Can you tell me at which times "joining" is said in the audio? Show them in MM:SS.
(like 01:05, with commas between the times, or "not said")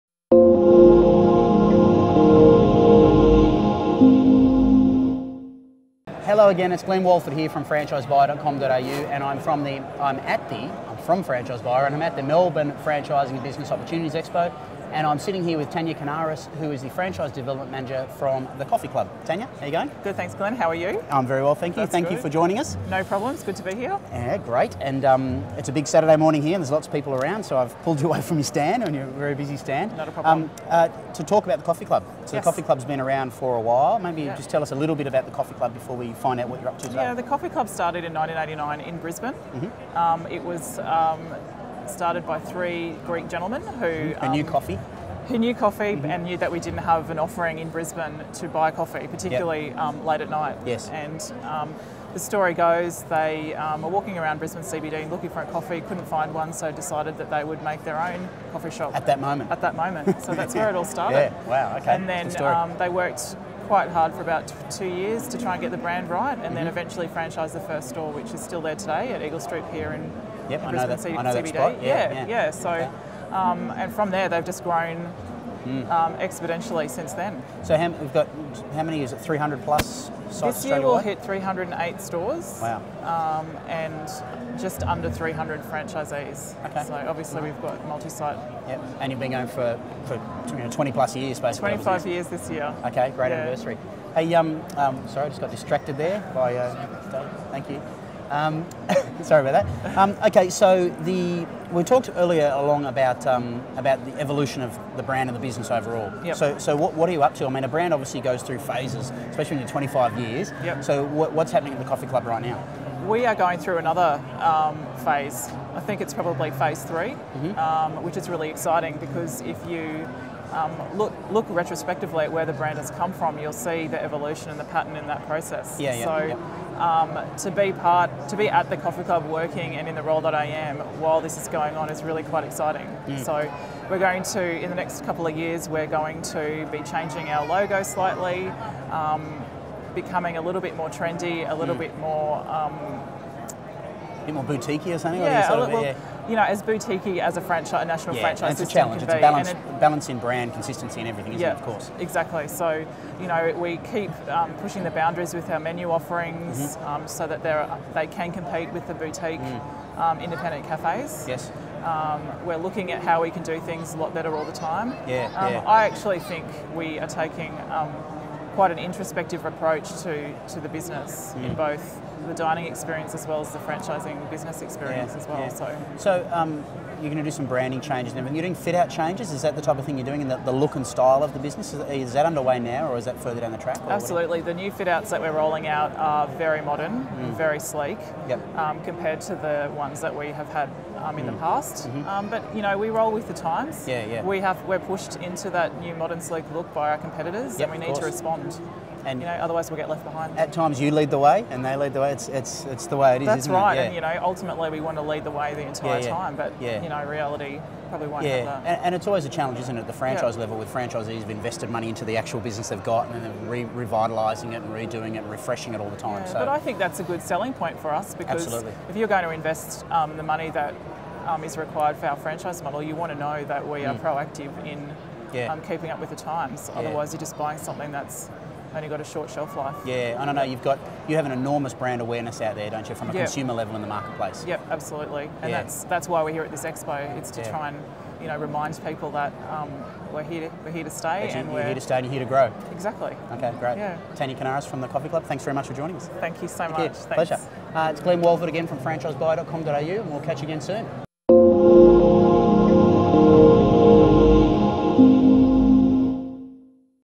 00:22, 04:05.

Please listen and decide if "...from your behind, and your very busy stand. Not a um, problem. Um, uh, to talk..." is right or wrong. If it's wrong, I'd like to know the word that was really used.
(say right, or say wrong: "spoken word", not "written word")
wrong: "stand", not "behind".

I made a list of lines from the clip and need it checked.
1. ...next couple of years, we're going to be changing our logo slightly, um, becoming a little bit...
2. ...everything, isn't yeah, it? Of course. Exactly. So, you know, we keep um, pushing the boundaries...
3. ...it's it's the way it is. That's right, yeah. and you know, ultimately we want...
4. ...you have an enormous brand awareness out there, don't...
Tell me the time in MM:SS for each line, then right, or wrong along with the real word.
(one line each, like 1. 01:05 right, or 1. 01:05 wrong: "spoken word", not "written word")
1. 02:14 right
2. 02:31 right
3. 03:22 right
4. 03:51 right.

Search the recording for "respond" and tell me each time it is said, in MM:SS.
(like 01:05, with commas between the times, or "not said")
03:18.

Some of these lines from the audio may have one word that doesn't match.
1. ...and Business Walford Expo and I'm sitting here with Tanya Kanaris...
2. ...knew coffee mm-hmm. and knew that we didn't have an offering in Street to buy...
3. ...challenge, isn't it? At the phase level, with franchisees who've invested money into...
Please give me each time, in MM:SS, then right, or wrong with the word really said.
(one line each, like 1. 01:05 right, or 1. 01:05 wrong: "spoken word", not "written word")
1. 00:13 wrong: "Opportunities", not "Walford"
2. 00:45 wrong: "Brisbane", not "Street"
3. 03:29 wrong: "franchise", not "phase".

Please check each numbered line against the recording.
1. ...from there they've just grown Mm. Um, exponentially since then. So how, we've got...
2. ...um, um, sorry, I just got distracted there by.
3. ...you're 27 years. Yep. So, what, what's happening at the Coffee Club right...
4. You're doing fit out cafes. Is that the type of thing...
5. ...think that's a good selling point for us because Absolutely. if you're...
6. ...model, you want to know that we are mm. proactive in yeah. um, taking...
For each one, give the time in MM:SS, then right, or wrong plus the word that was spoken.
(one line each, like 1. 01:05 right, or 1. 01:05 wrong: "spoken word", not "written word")
1. 01:13 right
2. 01:34 right
3. 01:49 wrong: "25", not "27"
4. 02:58 wrong: "changes", not "cafes"
5. 03:36 right
6. 03:42 wrong: "keeping", not "taking".